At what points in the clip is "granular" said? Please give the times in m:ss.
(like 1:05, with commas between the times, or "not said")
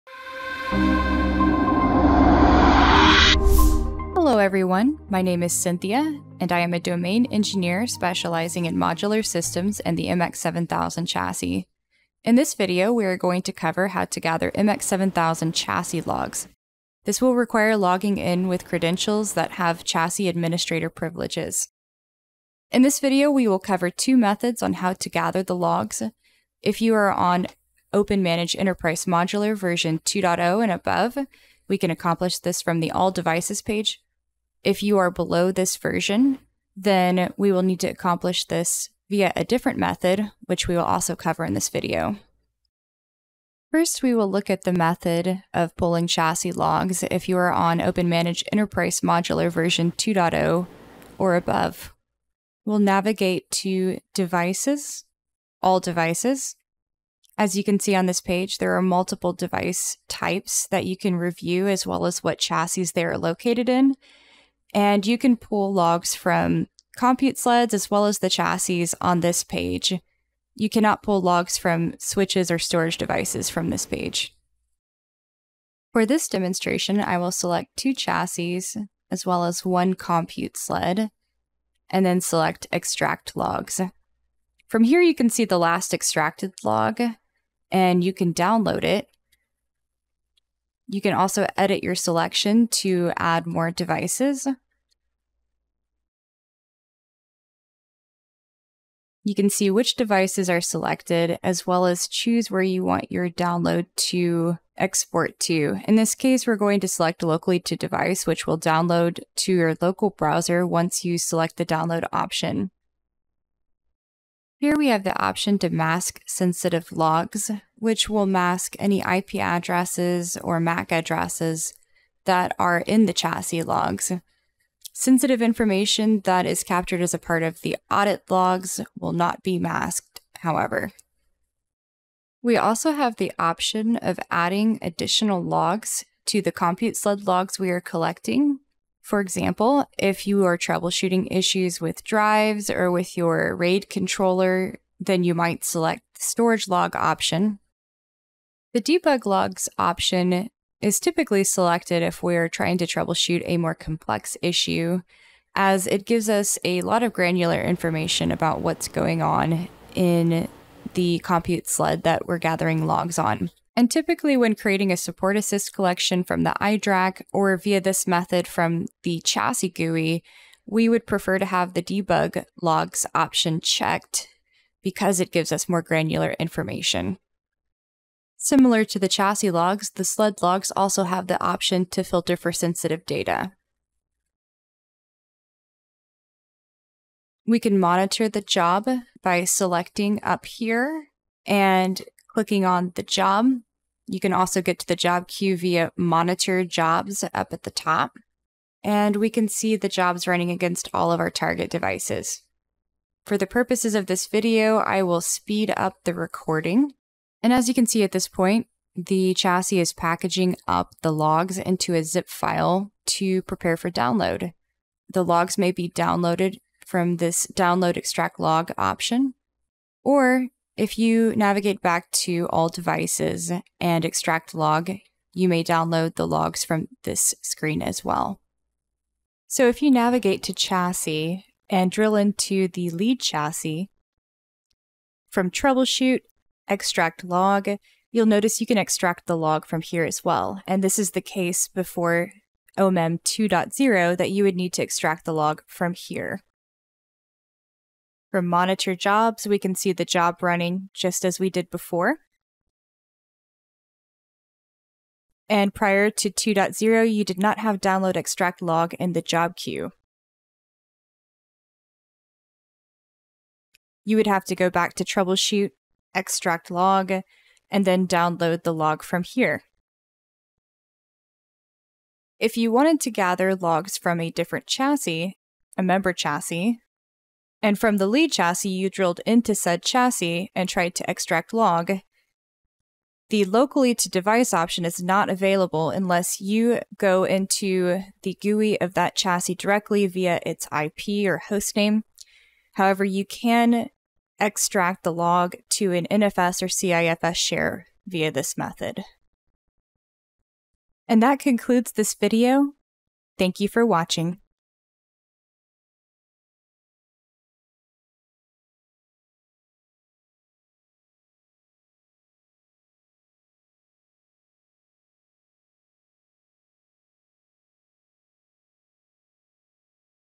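2:37, 2:55.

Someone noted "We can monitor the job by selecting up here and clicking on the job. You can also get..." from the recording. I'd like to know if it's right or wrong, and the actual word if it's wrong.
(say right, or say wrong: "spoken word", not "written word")
right.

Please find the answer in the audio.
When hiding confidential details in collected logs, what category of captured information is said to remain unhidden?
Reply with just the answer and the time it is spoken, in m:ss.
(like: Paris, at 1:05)
audit logs, at 2:07.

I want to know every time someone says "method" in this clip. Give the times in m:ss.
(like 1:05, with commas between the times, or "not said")
0:24, 0:39, 0:44, 2:48, 4:58.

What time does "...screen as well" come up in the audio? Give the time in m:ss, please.
3:47.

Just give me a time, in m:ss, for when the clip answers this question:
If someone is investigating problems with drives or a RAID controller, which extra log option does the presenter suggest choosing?
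2:26.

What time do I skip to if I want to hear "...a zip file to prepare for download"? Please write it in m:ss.
3:31.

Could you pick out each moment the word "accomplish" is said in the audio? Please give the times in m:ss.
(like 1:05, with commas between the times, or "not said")
0:31, 0:37.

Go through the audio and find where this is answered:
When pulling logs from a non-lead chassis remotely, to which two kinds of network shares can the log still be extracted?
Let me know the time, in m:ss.
4:56.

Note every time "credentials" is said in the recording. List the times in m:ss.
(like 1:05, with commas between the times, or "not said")
0:18.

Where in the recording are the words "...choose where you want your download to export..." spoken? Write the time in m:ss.
1:42.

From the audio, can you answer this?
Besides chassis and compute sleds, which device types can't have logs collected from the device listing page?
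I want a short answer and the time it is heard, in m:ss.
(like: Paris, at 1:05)
switches or storage devices, at 1:11.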